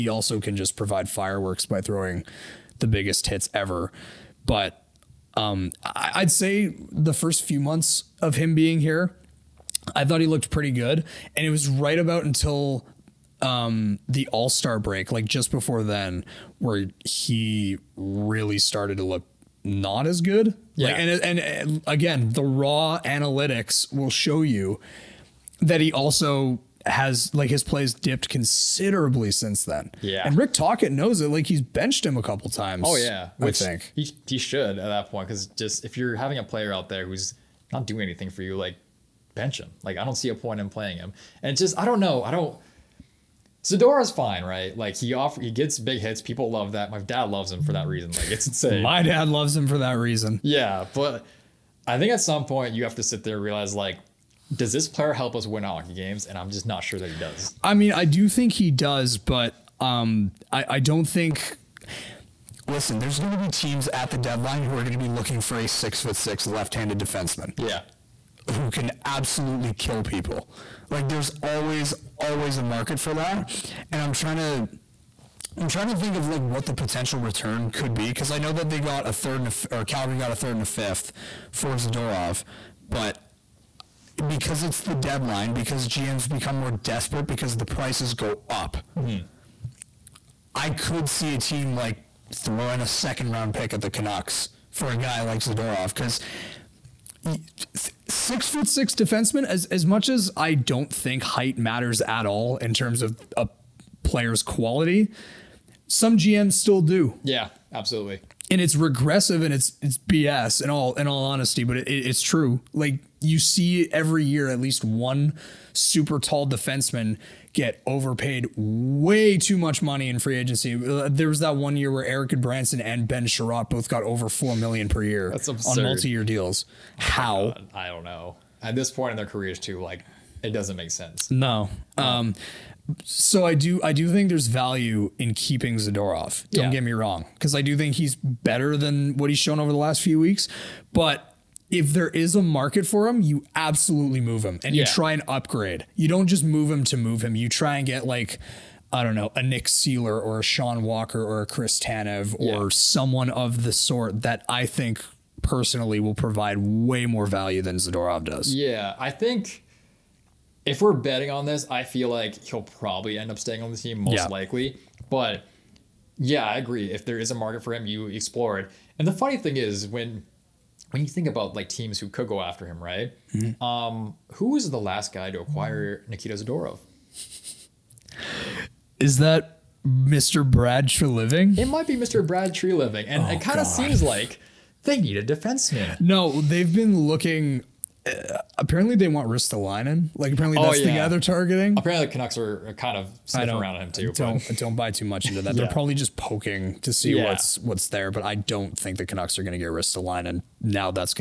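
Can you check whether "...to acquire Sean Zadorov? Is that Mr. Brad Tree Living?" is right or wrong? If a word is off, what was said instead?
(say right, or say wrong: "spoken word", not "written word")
wrong: "Nikita", not "Sean".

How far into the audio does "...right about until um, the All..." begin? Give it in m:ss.
0:11.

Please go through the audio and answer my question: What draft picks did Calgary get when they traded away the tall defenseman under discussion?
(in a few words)
A third and a fifth.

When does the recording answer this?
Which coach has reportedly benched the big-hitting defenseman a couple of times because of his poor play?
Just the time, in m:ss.
0:30.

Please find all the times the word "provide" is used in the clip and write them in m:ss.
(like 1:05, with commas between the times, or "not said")
0:00, 2:36.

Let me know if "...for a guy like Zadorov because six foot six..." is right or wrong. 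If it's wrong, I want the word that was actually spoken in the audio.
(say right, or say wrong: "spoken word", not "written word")
right.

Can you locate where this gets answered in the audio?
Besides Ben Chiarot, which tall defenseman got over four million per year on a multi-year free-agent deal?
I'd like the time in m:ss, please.
2:02.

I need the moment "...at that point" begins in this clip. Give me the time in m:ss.
0:34.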